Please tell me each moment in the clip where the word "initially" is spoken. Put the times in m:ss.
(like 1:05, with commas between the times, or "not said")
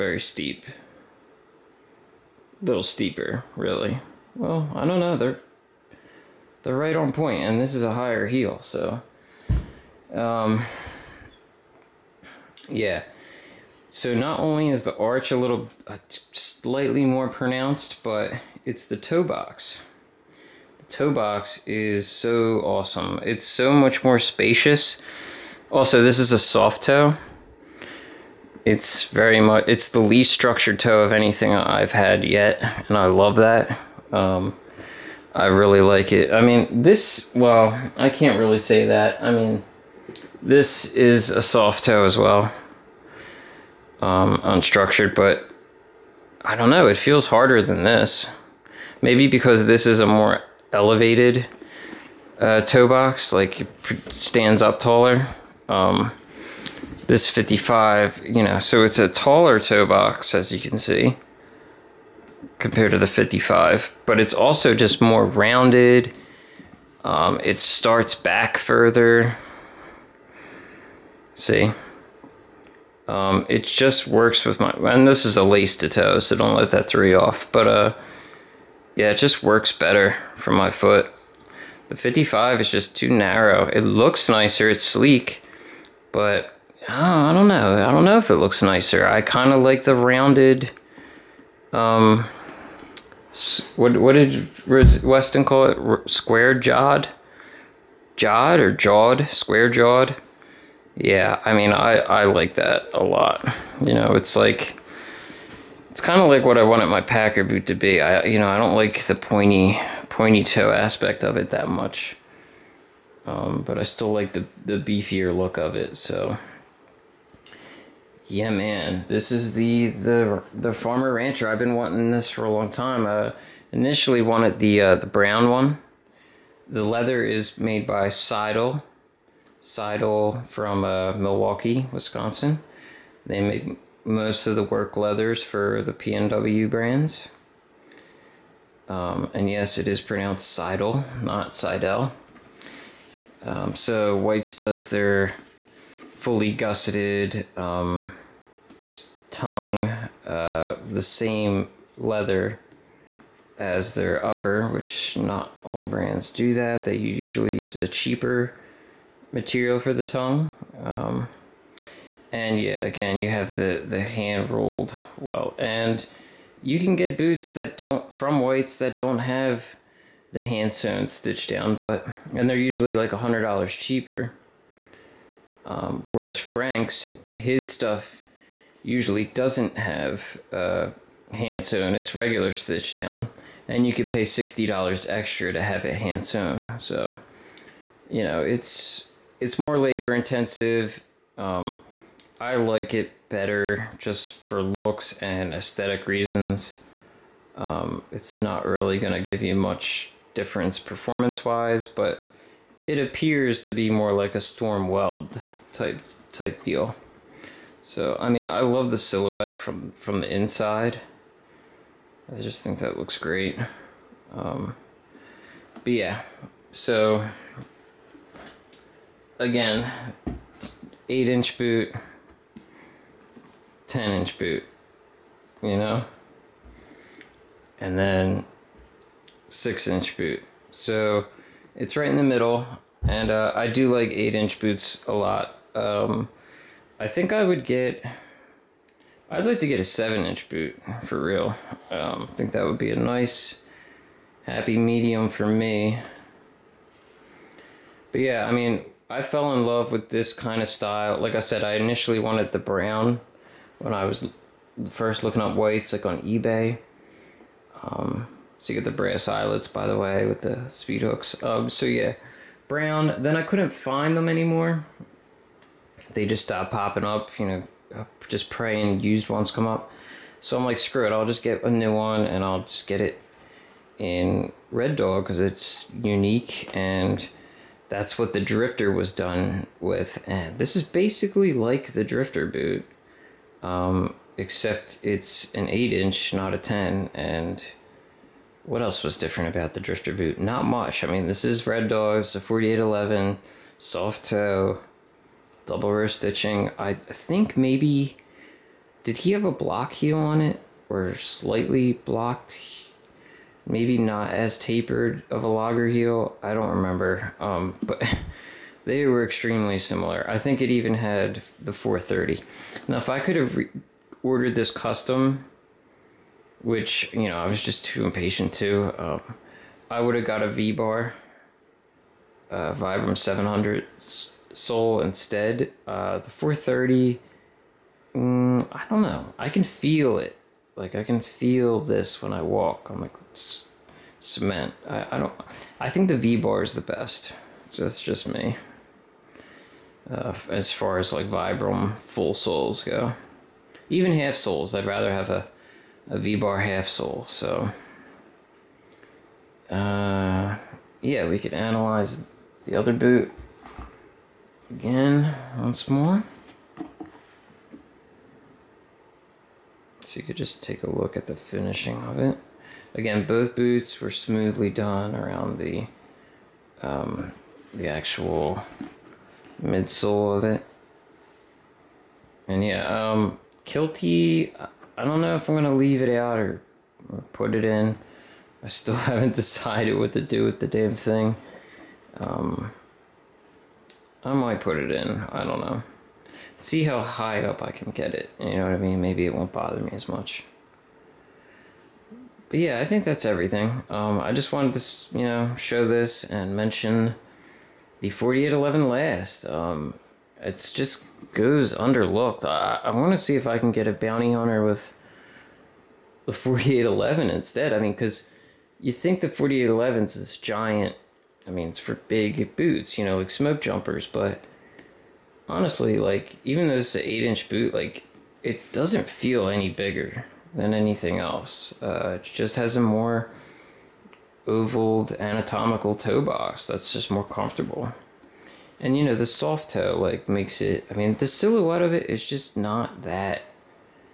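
2:03, 4:11.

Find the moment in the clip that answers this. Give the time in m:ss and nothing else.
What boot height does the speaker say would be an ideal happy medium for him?
3:59.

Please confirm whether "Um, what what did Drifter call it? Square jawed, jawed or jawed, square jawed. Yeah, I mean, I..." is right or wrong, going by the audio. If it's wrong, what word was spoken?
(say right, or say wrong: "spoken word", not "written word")
wrong: "Weston", not "Drifter".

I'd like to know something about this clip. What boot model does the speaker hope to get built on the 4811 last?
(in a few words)
bounty hunter.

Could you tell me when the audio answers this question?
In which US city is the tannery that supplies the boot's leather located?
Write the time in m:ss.
2:11.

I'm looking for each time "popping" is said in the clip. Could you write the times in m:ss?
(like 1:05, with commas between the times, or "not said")
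4:26.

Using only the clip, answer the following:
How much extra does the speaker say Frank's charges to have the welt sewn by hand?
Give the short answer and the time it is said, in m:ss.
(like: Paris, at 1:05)
$60, at 3:04.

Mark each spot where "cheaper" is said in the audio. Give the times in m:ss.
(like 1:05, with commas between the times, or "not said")
2:37, 2:53.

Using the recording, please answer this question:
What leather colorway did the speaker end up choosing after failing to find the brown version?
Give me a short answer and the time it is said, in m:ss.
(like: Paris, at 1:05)
Red Dog, at 4:34.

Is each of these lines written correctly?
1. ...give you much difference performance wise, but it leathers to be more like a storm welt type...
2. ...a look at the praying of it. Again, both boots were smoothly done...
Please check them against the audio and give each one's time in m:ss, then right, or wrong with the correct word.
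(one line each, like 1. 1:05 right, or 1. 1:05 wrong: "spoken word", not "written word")
1. 3:19 wrong: "appears", not "leathers"
2. 6:00 wrong: "finishing", not "praying".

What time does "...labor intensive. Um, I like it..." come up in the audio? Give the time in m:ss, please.
3:09.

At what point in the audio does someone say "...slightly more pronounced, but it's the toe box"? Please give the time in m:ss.
0:16.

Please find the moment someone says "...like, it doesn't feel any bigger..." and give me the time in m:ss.
6:57.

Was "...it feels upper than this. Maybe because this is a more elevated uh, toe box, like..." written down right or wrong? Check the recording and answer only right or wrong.
wrong.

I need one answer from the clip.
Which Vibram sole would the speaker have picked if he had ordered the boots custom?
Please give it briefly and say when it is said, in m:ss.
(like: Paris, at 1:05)
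Vibram 700, at 5:22.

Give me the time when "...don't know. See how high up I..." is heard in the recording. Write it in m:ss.
6:25.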